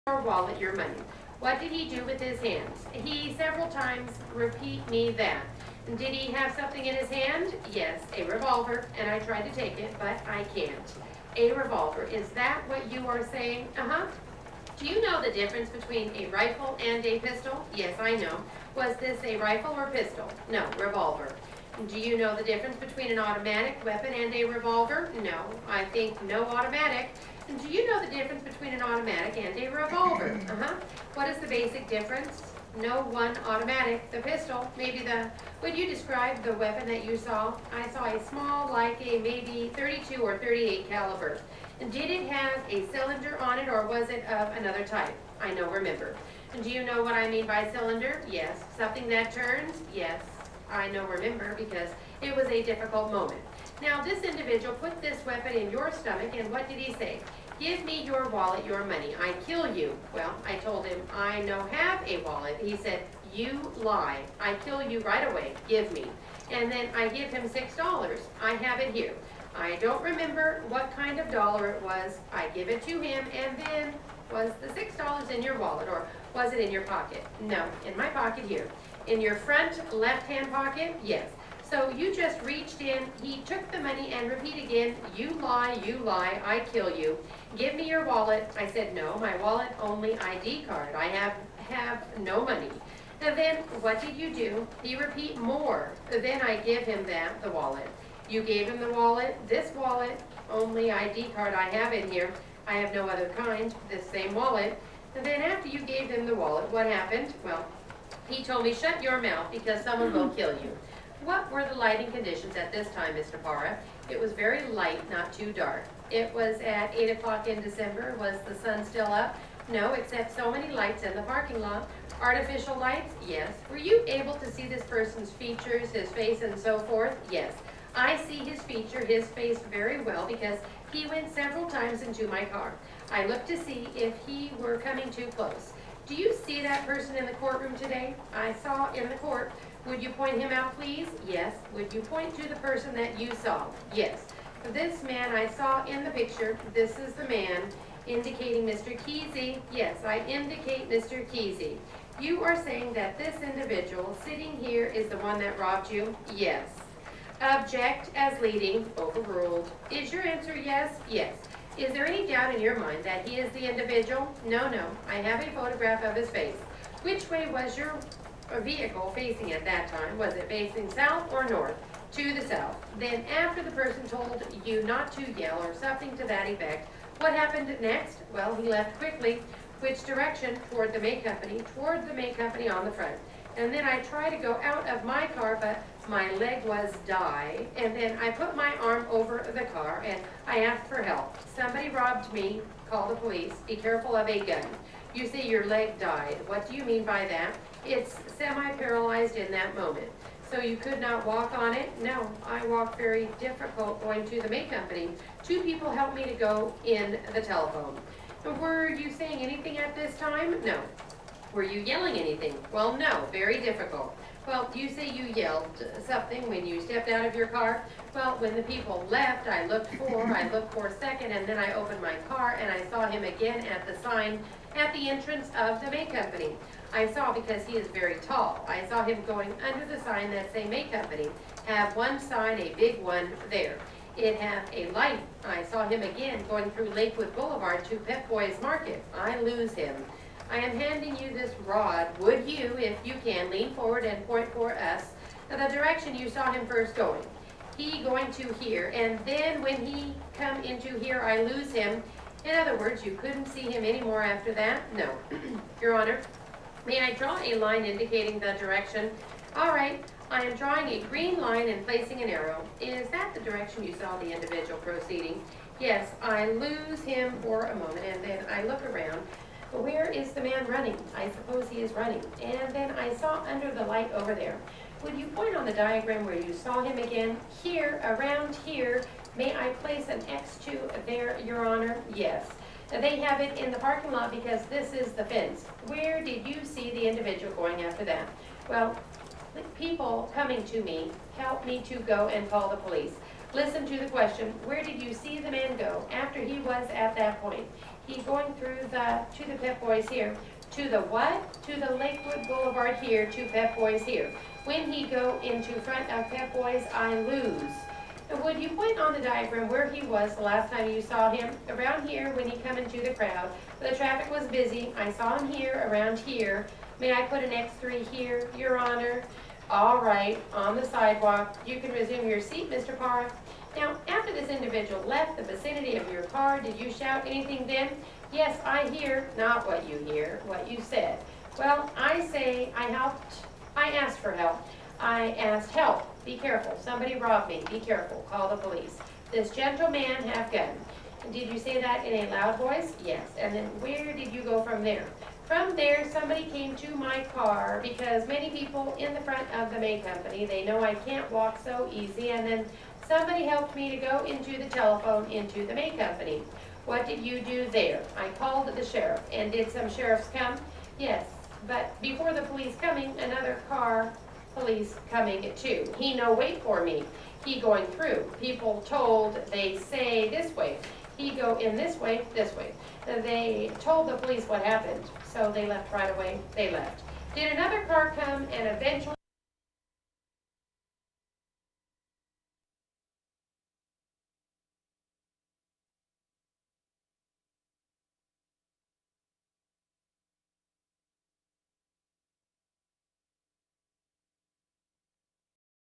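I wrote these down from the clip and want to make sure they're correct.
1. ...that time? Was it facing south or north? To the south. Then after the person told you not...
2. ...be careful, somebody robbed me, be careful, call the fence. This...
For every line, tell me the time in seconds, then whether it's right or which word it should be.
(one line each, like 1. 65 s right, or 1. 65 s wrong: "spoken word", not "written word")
1. 169 s right
2. 336 s wrong: "police", not "fence".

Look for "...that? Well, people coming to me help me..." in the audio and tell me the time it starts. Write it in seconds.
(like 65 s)
288 s.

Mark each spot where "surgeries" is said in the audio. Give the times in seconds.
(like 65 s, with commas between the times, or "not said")
not said.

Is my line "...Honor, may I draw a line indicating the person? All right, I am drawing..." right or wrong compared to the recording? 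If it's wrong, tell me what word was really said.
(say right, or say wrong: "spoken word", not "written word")
wrong: "direction", not "person".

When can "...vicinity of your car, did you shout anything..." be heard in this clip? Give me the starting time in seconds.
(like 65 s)
325 s.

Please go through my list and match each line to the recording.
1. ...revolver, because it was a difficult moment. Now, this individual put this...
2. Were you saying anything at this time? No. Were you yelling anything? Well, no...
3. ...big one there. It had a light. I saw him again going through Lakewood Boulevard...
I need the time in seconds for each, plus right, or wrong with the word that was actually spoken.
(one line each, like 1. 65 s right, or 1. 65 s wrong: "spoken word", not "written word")
1. 51 s wrong: "remember", not "revolver"
2. 208 s right
3. 232 s right.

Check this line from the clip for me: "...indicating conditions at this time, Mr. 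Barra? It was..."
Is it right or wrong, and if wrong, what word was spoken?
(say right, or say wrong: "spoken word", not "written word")
wrong: "lighting", not "indicating".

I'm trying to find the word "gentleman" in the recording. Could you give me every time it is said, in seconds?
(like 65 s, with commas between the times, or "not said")
339 s.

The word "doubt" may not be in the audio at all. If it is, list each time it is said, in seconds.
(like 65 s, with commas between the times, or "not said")
162 s.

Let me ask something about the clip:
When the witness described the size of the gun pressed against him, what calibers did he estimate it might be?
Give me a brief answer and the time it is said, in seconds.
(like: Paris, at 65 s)
32 or 38, at 39 s.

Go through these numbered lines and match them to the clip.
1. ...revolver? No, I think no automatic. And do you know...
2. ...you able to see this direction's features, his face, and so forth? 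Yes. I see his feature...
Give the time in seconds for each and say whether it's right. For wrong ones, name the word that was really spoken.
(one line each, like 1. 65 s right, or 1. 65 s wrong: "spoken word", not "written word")
1. 24 s right
2. 123 s wrong: "person", not "direction".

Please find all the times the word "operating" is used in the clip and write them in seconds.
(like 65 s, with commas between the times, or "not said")
not said.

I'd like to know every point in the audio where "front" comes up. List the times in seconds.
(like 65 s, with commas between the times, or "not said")
79 s, 182 s, 305 s, 349 s.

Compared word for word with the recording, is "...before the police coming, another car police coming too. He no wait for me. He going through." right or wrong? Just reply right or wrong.
right.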